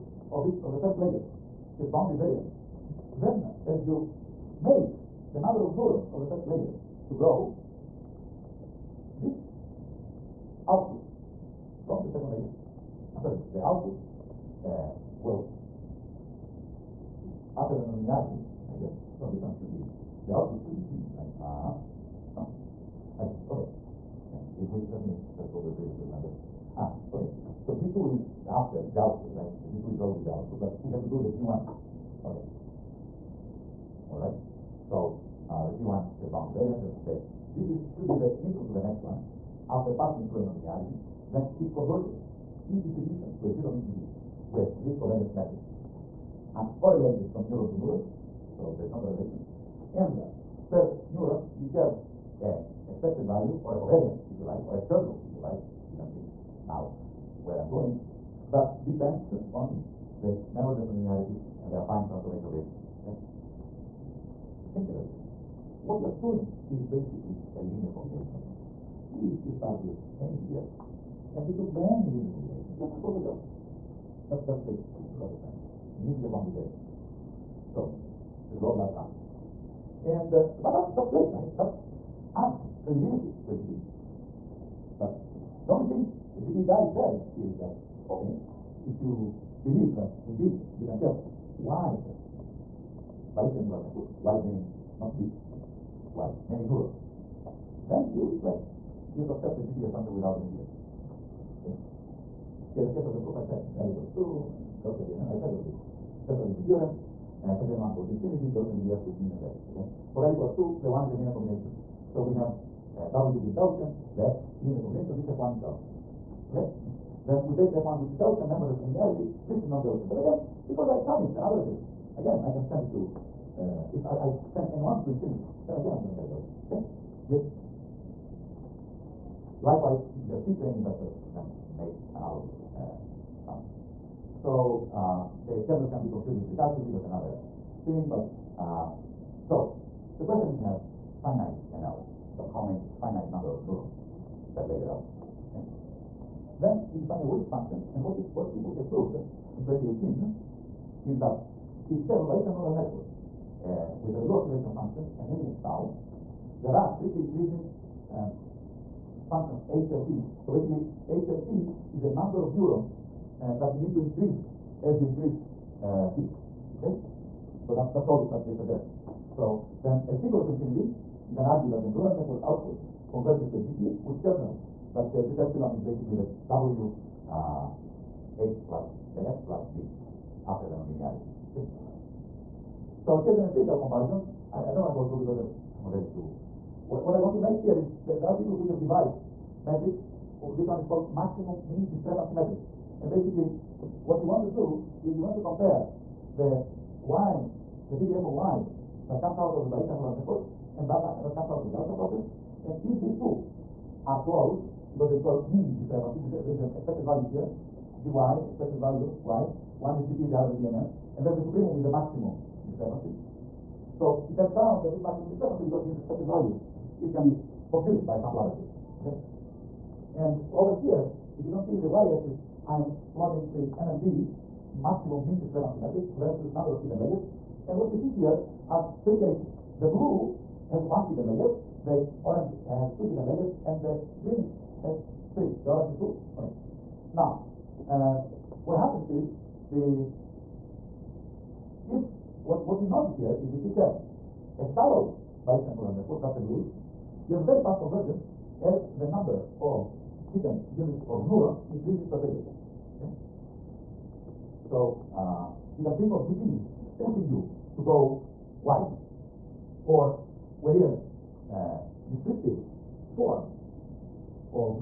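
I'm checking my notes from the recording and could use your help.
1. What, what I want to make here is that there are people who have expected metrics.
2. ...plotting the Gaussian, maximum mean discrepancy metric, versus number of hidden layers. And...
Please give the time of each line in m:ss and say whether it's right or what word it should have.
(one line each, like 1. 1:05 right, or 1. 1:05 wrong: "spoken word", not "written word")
1. 3:06 wrong: "devised", not "expected"
2. 3:43 wrong: "MMD", not "Gaussian".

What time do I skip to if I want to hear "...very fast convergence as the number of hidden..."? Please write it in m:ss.
4:07.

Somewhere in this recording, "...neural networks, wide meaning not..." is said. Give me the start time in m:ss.
1:33.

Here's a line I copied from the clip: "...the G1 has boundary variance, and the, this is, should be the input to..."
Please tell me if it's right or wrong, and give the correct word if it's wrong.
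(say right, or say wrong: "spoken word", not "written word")
right.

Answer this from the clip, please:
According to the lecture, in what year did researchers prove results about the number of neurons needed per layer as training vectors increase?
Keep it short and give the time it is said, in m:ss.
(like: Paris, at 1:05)
2018, at 2:29.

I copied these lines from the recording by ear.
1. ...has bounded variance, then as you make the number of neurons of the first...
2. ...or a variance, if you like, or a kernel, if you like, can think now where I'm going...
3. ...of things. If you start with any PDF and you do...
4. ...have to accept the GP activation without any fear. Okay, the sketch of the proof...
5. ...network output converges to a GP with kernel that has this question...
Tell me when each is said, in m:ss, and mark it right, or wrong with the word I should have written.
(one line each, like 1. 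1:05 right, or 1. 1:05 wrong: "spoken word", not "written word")
1. 0:01 right
2. 0:53 wrong: "covariance", not "variance"
3. 1:08 right
4. 1:39 wrong: "assumption", not "activation"
5. 2:52 wrong: "epsilon", not "question".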